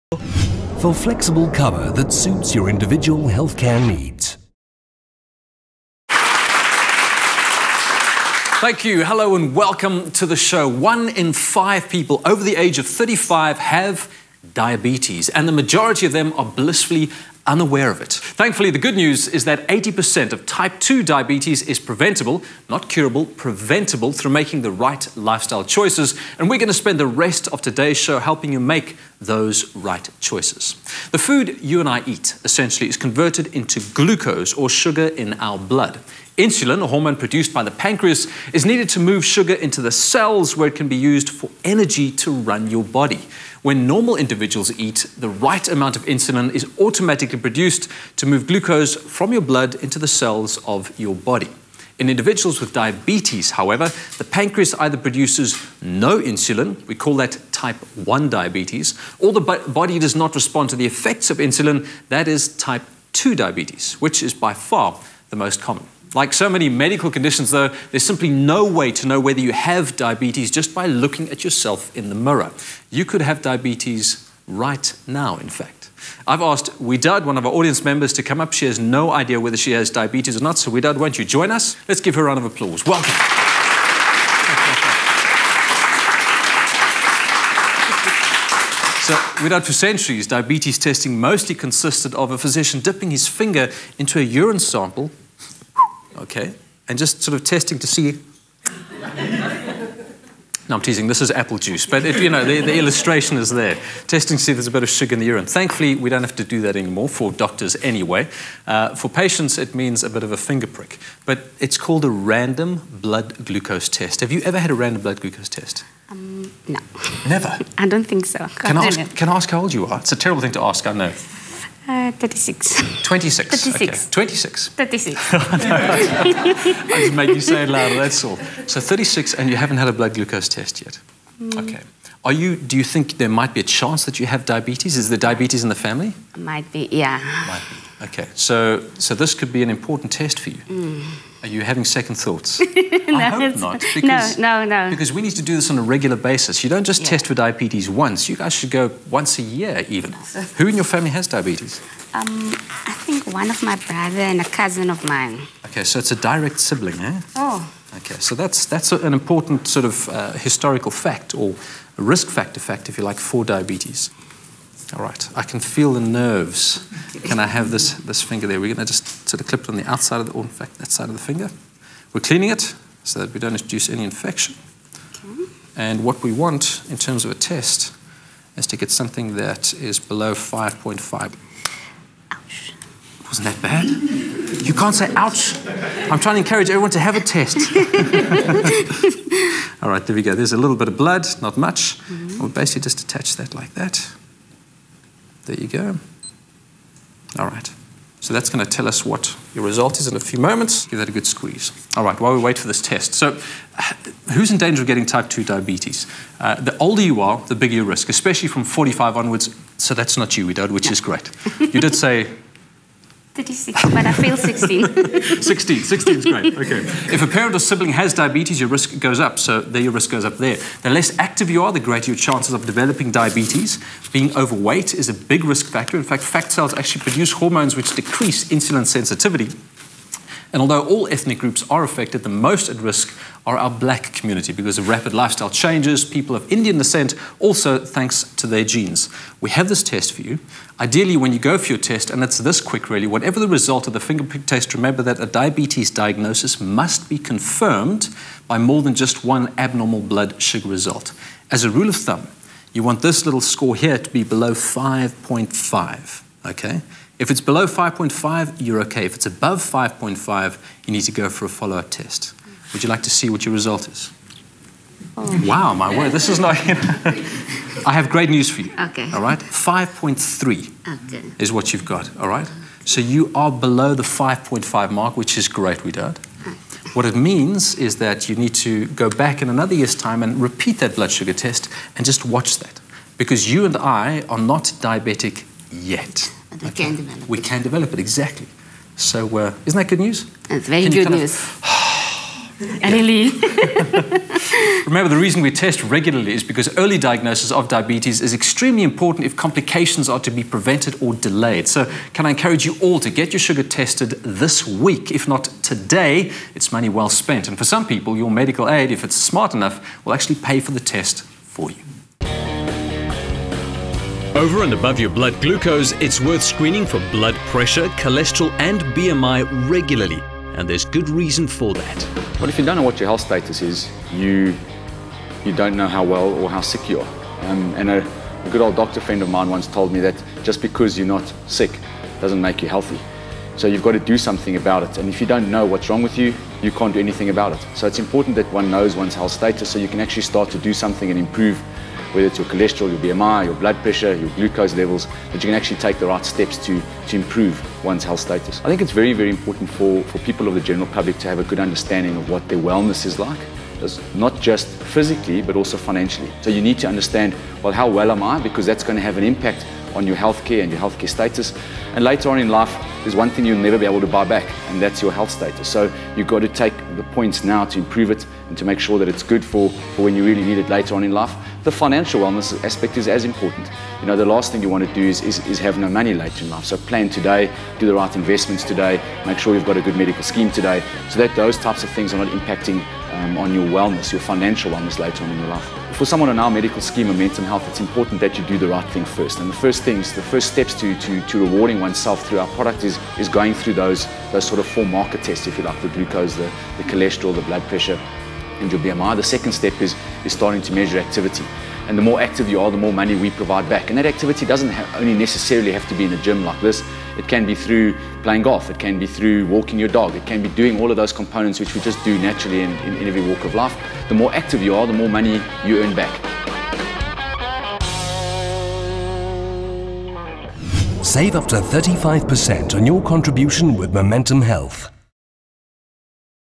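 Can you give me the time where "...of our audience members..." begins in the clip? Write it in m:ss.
1:17.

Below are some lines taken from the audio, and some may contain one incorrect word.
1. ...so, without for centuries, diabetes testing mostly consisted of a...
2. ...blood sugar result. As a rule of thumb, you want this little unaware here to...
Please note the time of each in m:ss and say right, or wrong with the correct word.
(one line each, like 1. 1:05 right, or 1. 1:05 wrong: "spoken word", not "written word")
1. 1:29 right
2. 4:10 wrong: "score", not "unaware".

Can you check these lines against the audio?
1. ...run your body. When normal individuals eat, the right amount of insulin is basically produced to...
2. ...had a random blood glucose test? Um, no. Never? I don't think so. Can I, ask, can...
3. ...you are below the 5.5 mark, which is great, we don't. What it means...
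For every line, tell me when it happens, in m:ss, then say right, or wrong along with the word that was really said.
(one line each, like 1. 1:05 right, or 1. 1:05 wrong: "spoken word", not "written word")
1. 0:42 wrong: "automatically", not "basically"
2. 1:54 right
3. 4:33 right.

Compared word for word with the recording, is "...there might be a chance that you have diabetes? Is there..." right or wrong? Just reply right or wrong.
right.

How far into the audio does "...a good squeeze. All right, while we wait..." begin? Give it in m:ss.
3:21.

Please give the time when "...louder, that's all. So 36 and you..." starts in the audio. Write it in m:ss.
2:07.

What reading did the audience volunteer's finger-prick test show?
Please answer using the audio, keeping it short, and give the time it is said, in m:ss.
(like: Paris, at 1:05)
5.3, at 4:29.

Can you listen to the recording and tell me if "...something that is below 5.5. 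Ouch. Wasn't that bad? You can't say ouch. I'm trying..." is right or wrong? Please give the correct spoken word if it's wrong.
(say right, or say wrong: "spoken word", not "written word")
right.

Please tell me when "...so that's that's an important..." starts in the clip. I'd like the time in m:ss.
2:38.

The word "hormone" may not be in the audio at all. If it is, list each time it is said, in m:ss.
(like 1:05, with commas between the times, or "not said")
0:36, 3:47.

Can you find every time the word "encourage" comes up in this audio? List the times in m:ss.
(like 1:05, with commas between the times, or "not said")
3:06, 5:02.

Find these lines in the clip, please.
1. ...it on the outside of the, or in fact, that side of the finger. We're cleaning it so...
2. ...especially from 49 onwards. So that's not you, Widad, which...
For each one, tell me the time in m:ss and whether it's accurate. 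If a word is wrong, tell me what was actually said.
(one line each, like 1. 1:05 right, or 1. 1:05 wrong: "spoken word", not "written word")
1. 2:49 right
2. 3:28 wrong: "45", not "49".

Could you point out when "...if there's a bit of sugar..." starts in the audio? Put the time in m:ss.
1:44.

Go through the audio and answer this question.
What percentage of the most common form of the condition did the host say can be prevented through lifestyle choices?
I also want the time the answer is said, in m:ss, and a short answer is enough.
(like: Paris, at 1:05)
80%, at 0:19.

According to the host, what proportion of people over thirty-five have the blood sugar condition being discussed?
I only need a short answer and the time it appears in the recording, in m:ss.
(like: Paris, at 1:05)
One in five, at 0:10.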